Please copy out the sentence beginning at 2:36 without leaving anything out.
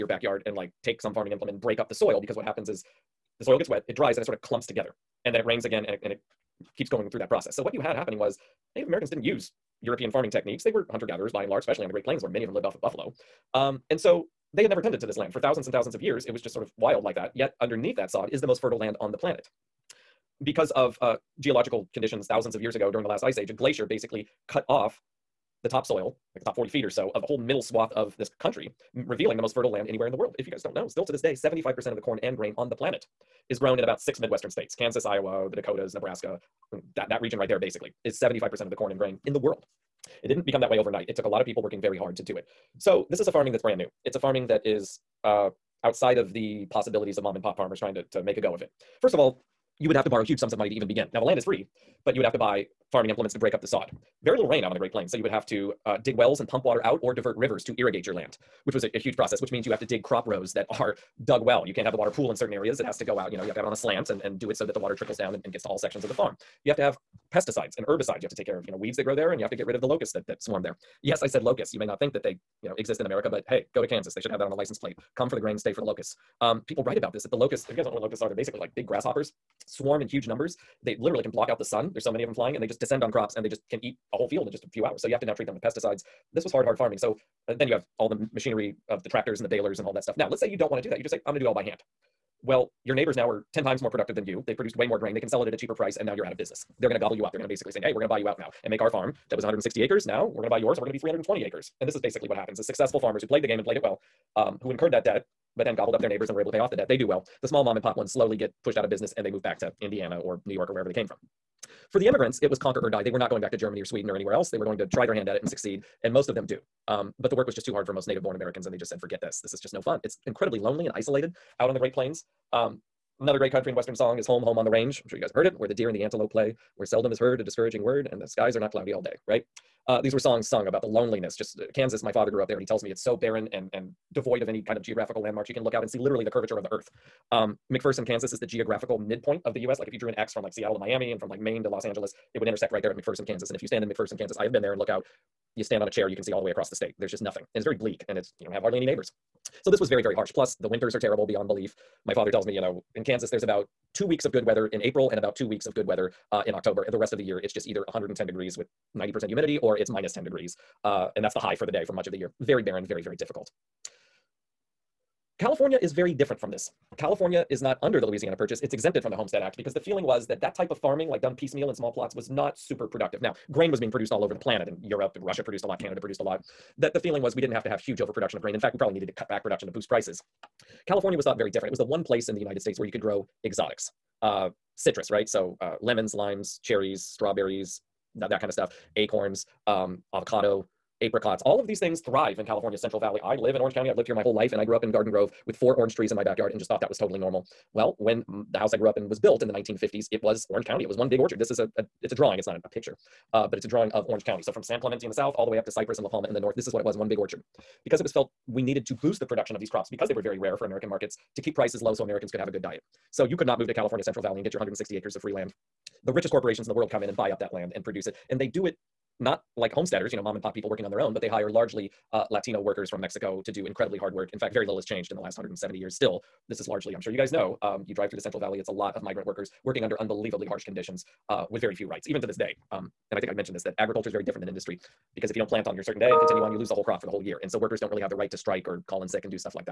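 And the rest of the year, it's just either 110 degrees with 90% humidity or it's minus 10 degrees.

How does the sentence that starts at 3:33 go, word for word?
So you could not move to California Central Valley and get your 160 acres of free land.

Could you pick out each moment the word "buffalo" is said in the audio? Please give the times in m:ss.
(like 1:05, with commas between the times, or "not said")
0:12.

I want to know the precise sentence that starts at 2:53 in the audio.
Now, grain was being produced all over the planet in Europe, Russia produced a lot, Canada produced a lot.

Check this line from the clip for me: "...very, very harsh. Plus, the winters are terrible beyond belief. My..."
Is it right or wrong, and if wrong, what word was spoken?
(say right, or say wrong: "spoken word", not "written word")
right.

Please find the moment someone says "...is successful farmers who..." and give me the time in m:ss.
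1:42.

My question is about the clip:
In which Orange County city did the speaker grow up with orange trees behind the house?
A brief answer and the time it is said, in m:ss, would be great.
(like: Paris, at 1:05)
Garden Grove, at 3:14.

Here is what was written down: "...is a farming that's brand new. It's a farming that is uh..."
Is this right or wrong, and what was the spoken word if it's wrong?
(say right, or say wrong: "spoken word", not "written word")
right.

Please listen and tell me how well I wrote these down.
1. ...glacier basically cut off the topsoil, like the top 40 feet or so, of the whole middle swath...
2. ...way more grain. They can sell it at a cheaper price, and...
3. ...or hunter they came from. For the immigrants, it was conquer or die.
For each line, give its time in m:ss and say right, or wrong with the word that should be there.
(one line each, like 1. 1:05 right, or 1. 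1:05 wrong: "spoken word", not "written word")
1. 0:23 right
2. 1:34 right
3. 1:50 wrong: "wherever", not "hunter".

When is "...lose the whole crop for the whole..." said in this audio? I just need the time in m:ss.
3:56.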